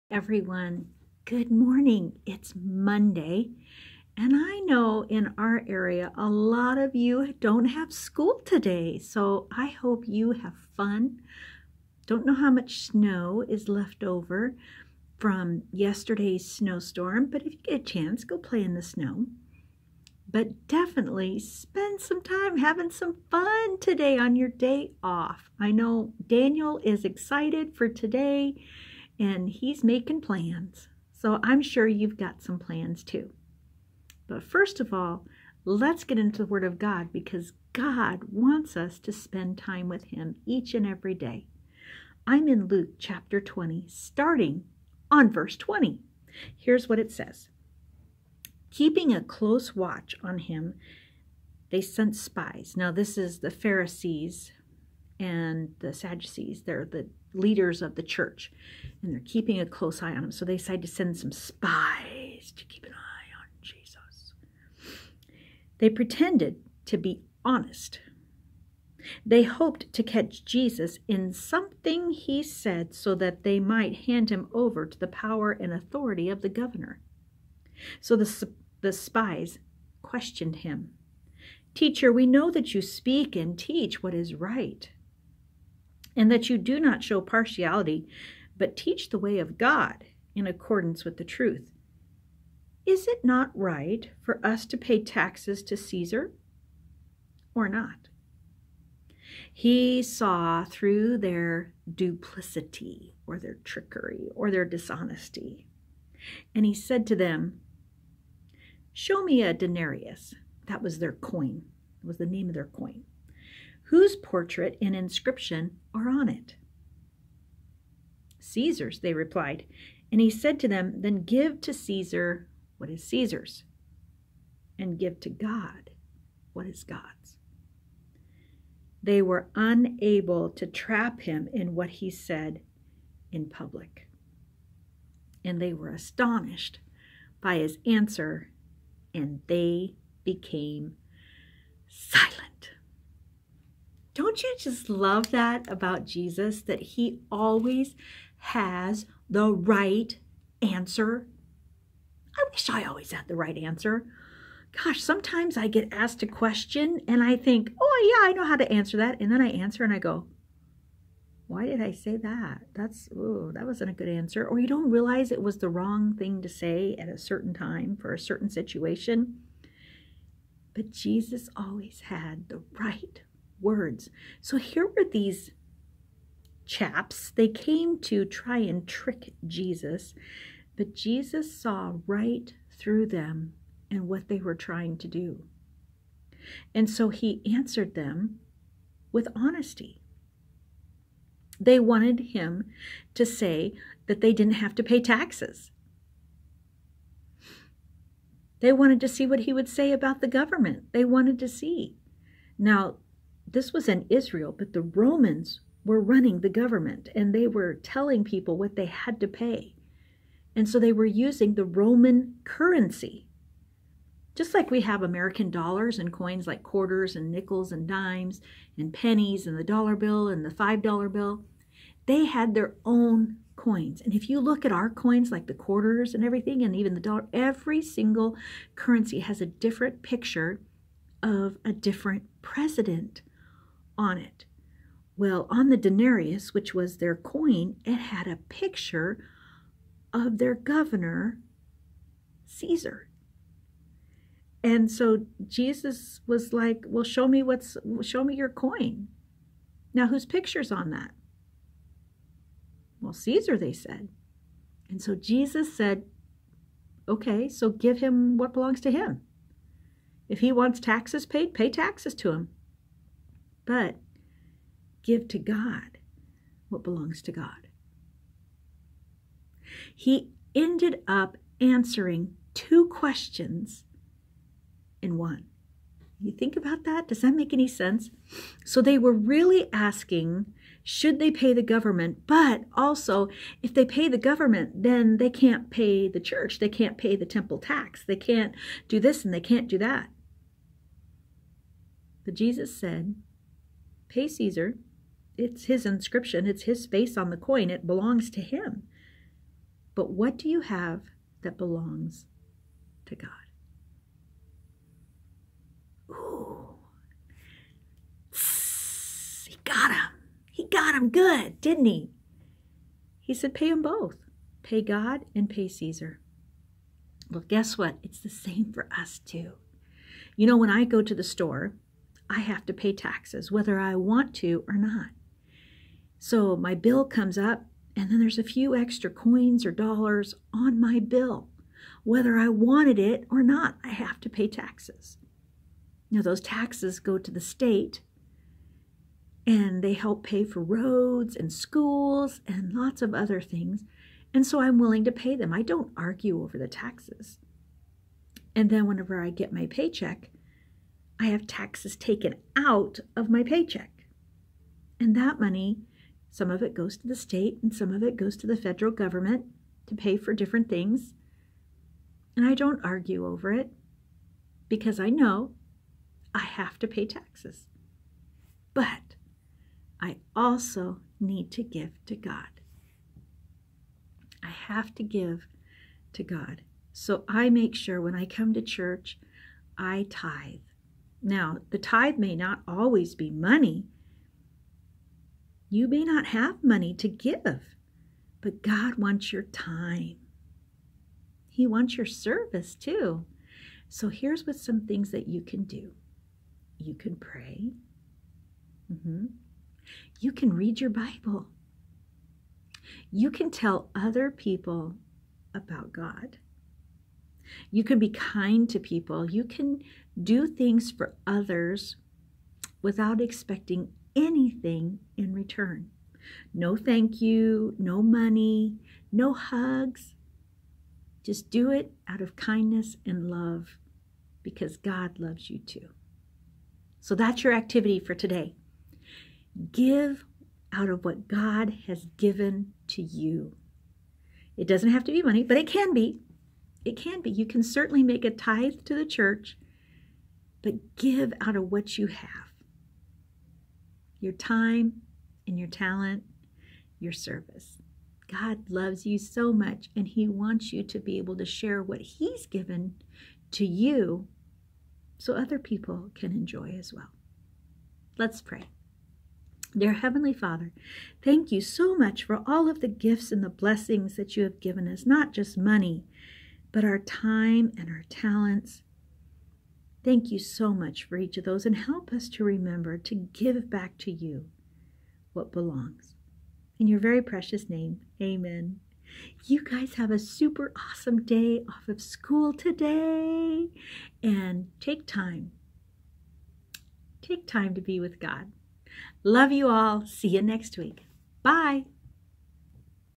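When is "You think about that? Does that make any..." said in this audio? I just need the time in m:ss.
4:36.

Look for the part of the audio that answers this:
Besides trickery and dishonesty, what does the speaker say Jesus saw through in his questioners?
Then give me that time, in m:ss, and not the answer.
1:41.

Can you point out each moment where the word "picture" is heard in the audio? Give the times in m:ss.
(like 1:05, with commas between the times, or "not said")
3:50, 3:58, 4:10.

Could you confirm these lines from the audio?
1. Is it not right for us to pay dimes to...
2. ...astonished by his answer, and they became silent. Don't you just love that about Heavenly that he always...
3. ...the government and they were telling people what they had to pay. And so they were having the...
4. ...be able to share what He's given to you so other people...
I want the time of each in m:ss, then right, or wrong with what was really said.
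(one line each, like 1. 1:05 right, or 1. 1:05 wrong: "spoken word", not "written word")
1. 1:32 wrong: "taxes", not "dimes"
2. 2:15 wrong: "Jesus", not "Heavenly"
3. 3:26 wrong: "using", not "having"
4. 7:30 right.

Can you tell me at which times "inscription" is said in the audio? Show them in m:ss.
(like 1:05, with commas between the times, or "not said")
1:54, 4:55.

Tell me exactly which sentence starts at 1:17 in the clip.
So the, the spies questioned him.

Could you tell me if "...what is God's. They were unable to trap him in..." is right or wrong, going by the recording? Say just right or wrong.
right.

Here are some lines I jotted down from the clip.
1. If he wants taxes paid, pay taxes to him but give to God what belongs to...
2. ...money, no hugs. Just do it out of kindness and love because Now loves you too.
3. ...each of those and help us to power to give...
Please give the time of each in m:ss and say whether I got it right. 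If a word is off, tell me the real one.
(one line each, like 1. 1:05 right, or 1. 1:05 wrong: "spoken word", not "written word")
1. 4:20 right
2. 6:58 wrong: "God", not "Now"
3. 7:51 wrong: "remember", not "power".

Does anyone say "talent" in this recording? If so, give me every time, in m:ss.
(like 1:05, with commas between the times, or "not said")
7:25, 7:48.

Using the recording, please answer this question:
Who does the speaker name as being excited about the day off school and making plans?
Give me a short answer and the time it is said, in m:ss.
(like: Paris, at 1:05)
Daniel, at 0:26.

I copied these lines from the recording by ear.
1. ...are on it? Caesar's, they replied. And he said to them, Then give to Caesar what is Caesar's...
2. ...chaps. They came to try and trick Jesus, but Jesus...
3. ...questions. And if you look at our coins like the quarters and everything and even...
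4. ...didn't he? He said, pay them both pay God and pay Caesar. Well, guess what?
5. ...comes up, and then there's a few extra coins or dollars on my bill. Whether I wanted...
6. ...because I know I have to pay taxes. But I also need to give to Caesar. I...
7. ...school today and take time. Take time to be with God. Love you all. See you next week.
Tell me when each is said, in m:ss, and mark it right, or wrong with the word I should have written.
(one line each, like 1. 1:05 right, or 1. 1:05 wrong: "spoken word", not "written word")
1. 1:55 right
2. 2:56 right
3. 3:43 wrong: "coins", not "questions"
4. 5:11 right
5. 5:27 right
6. 6:04 wrong: "God", not "Caesar"
7. 8:02 right.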